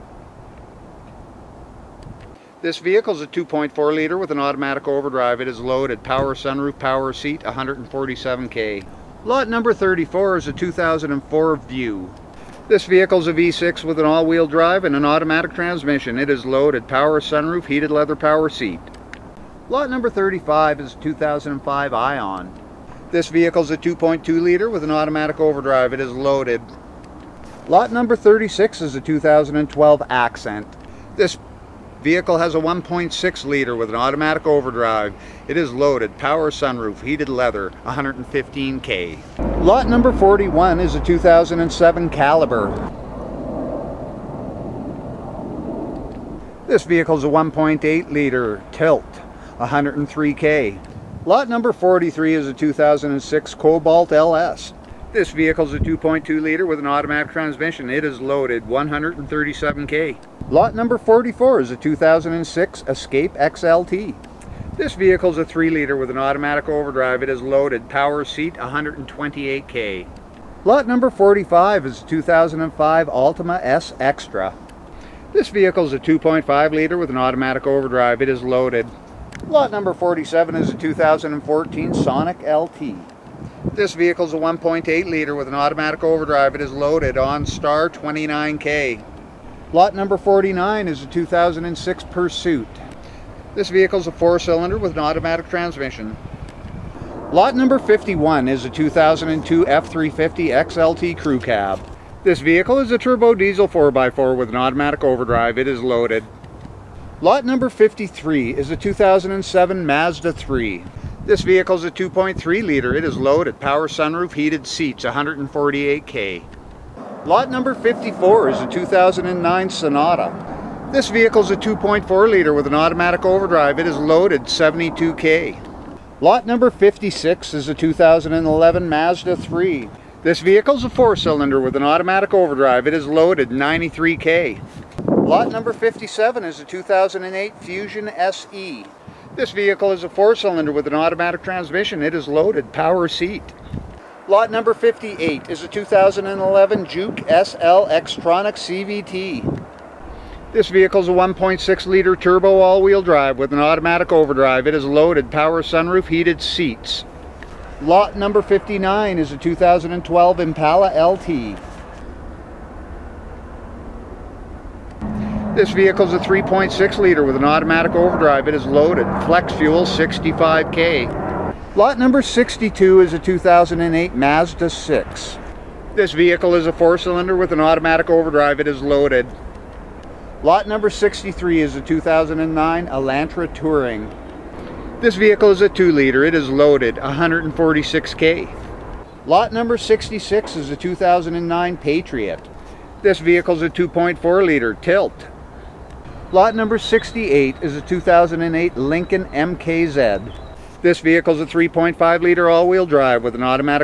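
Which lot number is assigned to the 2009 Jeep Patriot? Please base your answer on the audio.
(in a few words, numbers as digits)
66.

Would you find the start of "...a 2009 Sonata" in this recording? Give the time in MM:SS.
01:58.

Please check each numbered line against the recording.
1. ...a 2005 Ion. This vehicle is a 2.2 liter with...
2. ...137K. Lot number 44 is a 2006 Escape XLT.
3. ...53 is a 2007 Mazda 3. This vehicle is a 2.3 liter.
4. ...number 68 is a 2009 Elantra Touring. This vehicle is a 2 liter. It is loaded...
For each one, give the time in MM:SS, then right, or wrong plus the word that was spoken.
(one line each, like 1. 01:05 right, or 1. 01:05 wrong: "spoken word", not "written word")
1. 00:20 right
2. 00:58 right
3. 01:47 right
4. 03:00 wrong: "63", not "68".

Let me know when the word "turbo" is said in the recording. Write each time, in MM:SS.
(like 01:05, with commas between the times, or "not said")
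01:42, 02:32.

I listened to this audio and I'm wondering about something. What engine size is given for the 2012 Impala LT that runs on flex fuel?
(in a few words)
3.6 liter.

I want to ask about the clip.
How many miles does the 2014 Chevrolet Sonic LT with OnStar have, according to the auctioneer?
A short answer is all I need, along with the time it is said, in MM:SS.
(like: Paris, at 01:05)
29K, at 01:27.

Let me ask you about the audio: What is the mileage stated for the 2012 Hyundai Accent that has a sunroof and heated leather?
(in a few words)
115K.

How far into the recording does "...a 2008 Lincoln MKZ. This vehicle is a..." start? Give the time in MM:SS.
03:17.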